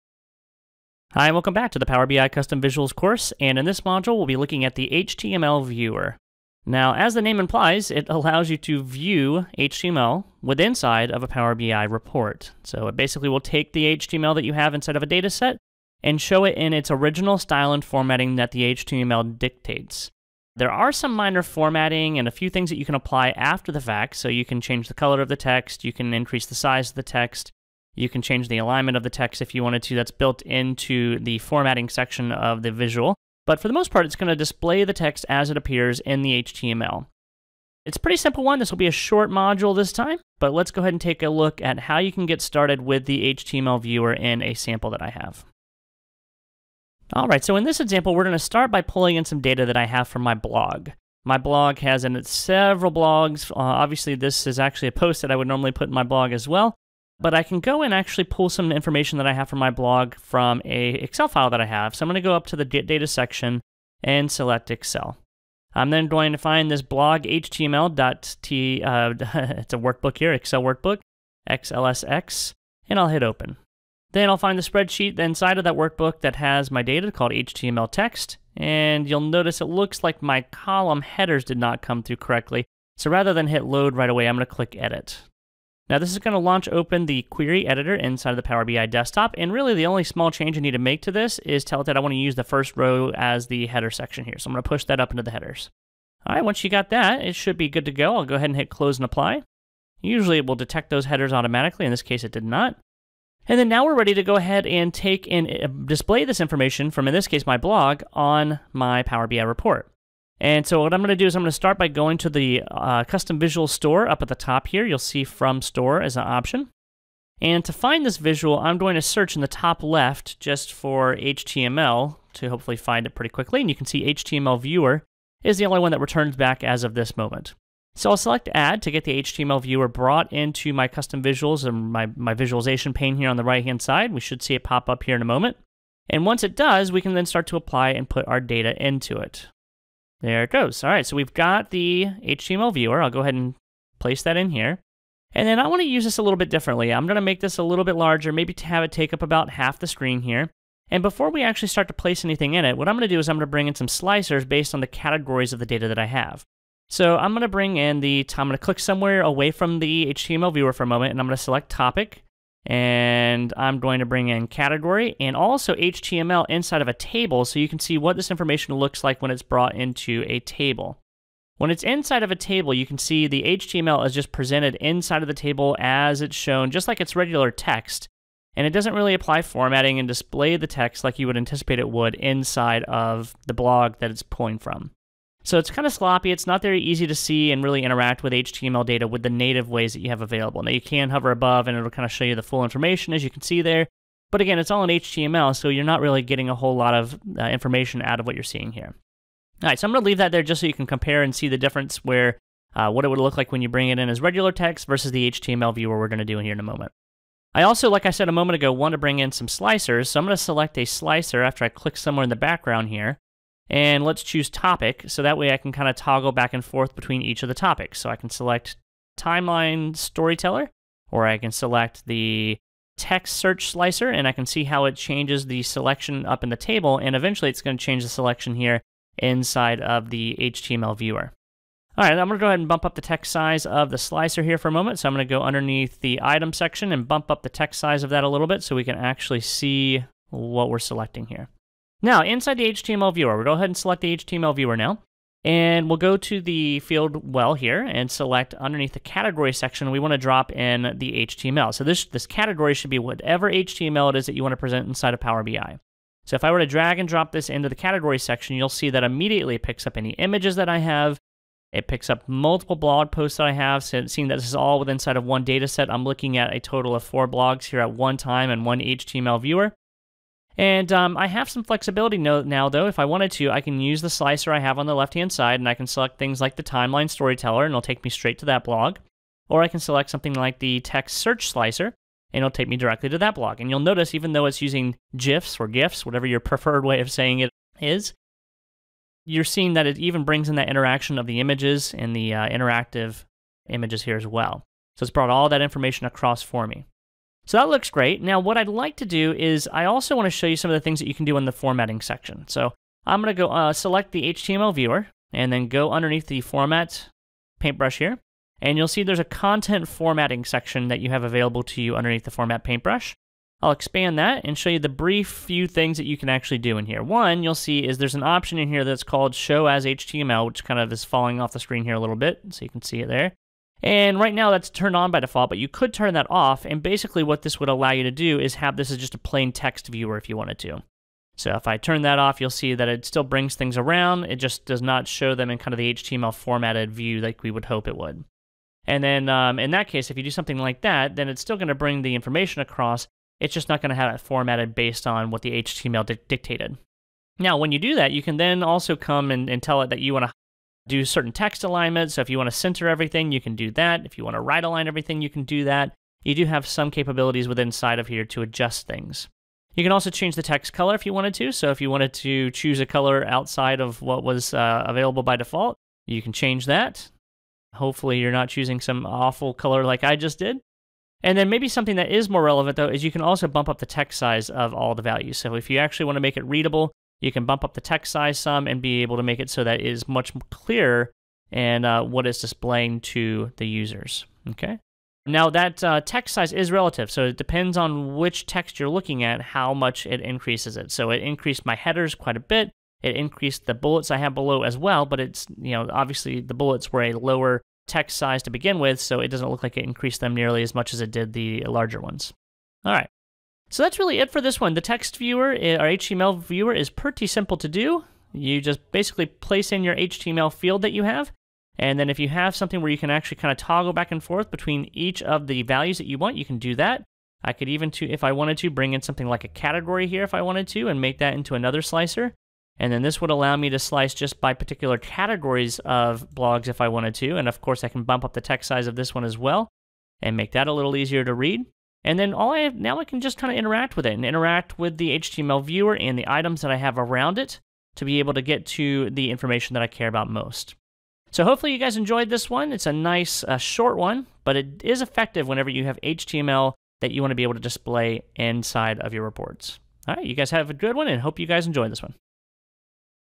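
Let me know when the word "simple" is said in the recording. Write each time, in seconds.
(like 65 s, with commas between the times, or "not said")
38 s, 407 s.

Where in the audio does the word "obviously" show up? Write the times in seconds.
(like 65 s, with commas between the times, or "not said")
53 s, 395 s.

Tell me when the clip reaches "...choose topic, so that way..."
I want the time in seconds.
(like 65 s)
214 s.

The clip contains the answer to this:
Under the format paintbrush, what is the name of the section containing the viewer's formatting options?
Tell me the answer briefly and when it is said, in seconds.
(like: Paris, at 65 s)
content formatting, at 309 s.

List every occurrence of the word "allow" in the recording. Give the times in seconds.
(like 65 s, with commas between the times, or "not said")
8 s, 327 s, 423 s.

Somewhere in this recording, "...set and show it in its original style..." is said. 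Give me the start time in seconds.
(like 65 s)
15 s.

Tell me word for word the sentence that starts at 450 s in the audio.
All right, you guys have a good one and hope you guys enjoyed this one.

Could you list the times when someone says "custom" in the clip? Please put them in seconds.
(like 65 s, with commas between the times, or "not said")
2 s, 113 s, 130 s.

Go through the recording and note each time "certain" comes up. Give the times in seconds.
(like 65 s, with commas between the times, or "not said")
351 s.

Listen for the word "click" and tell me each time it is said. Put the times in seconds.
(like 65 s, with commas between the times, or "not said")
84 s, 158 s, 211 s.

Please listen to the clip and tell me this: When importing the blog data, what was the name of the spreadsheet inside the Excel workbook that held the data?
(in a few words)
HTML text.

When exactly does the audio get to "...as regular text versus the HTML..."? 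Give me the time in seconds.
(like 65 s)
204 s.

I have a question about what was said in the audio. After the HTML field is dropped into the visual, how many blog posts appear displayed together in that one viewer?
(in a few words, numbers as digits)
4.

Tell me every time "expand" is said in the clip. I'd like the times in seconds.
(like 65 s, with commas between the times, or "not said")
313 s.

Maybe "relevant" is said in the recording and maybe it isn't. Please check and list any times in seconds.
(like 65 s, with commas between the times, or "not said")
372 s.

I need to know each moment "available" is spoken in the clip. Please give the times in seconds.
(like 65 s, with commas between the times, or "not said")
190 s, 311 s, 364 s.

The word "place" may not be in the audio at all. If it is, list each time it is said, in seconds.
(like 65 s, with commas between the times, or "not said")
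143 s, 151 s, 409 s.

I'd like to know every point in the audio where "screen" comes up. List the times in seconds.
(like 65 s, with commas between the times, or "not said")
149 s, 321 s.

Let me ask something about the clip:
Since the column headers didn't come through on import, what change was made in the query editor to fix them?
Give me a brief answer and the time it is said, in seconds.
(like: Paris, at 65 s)
use the first row as the header, at 92 s.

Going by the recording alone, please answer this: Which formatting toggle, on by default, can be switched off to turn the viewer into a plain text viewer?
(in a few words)
show as HTML.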